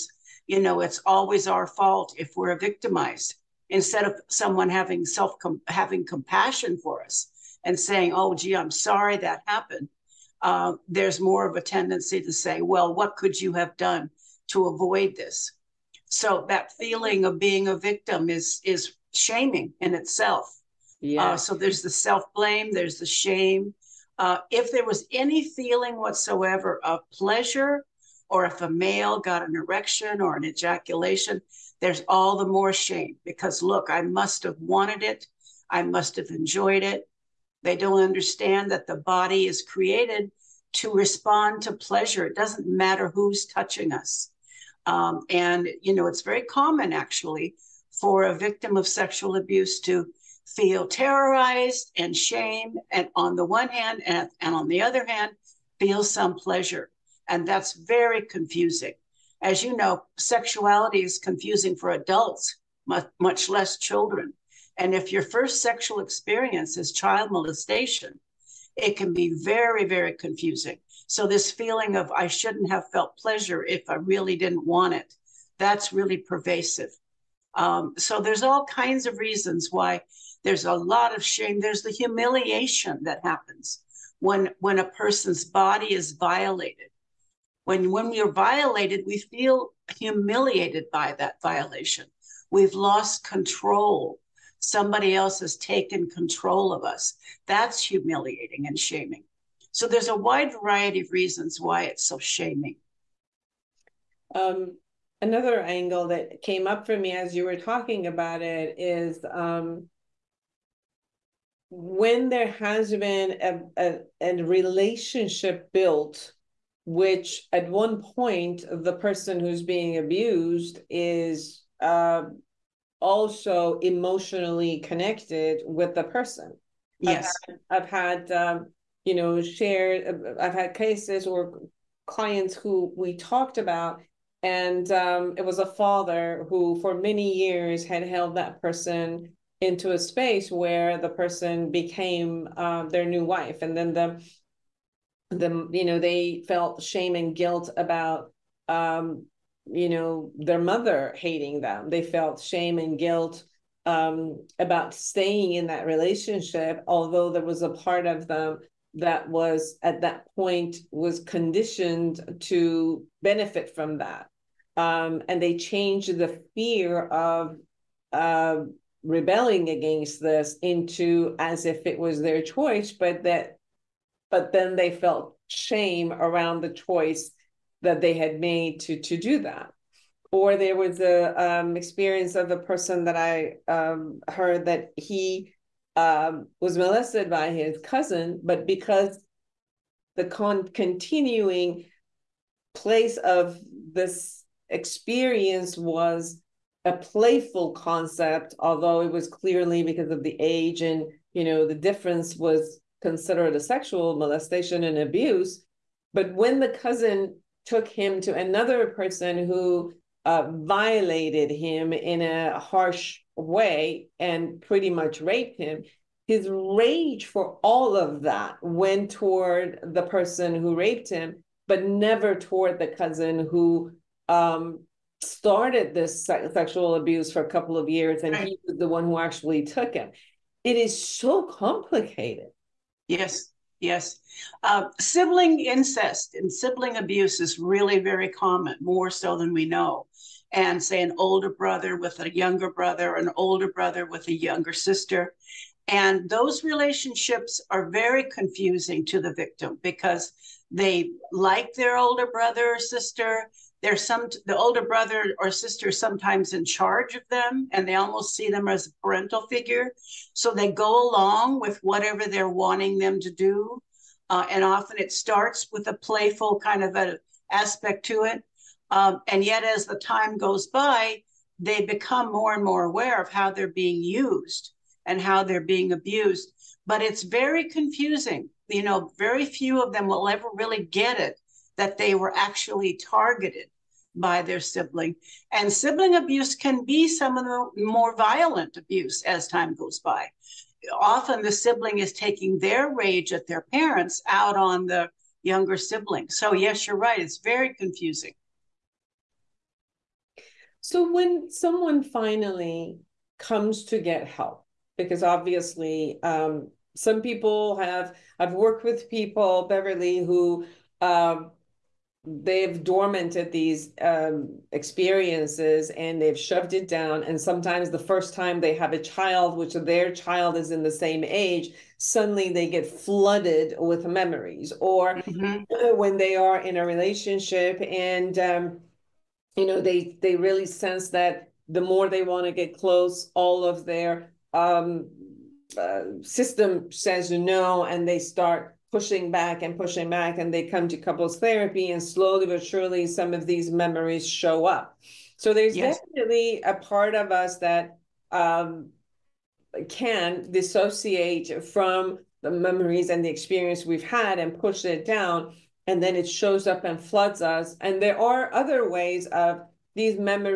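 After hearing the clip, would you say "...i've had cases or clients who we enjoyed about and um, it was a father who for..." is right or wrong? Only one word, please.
wrong.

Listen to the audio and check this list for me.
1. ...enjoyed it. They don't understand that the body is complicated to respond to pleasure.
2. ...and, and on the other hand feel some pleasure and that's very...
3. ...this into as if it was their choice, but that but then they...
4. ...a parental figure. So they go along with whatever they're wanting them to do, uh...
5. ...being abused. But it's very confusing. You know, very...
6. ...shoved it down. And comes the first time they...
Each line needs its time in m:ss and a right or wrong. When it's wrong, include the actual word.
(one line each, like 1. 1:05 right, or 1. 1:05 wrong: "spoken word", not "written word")
1. 0:36 wrong: "created", not "complicated"
2. 0:54 right
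3. 2:50 right
4. 4:18 right
5. 4:35 right
6. 5:16 wrong: "sometimes", not "comes".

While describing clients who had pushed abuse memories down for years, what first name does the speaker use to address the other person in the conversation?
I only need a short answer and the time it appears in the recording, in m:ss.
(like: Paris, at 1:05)
Beverly, at 5:09.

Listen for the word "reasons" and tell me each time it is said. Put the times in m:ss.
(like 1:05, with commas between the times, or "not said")
1:19, 1:41.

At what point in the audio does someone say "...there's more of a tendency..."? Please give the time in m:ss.
0:10.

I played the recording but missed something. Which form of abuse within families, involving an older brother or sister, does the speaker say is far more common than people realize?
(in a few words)
Sibling incest.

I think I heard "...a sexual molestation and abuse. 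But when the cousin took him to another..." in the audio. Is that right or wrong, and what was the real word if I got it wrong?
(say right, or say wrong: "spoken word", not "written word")
right.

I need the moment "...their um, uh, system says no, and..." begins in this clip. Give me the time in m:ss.
5:33.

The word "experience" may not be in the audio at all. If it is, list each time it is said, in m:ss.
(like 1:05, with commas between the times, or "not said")
1:05, 3:01, 3:14, 5:14, 5:53.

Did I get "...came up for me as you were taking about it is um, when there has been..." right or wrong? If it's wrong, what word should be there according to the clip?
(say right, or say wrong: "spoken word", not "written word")
wrong: "talking", not "taking".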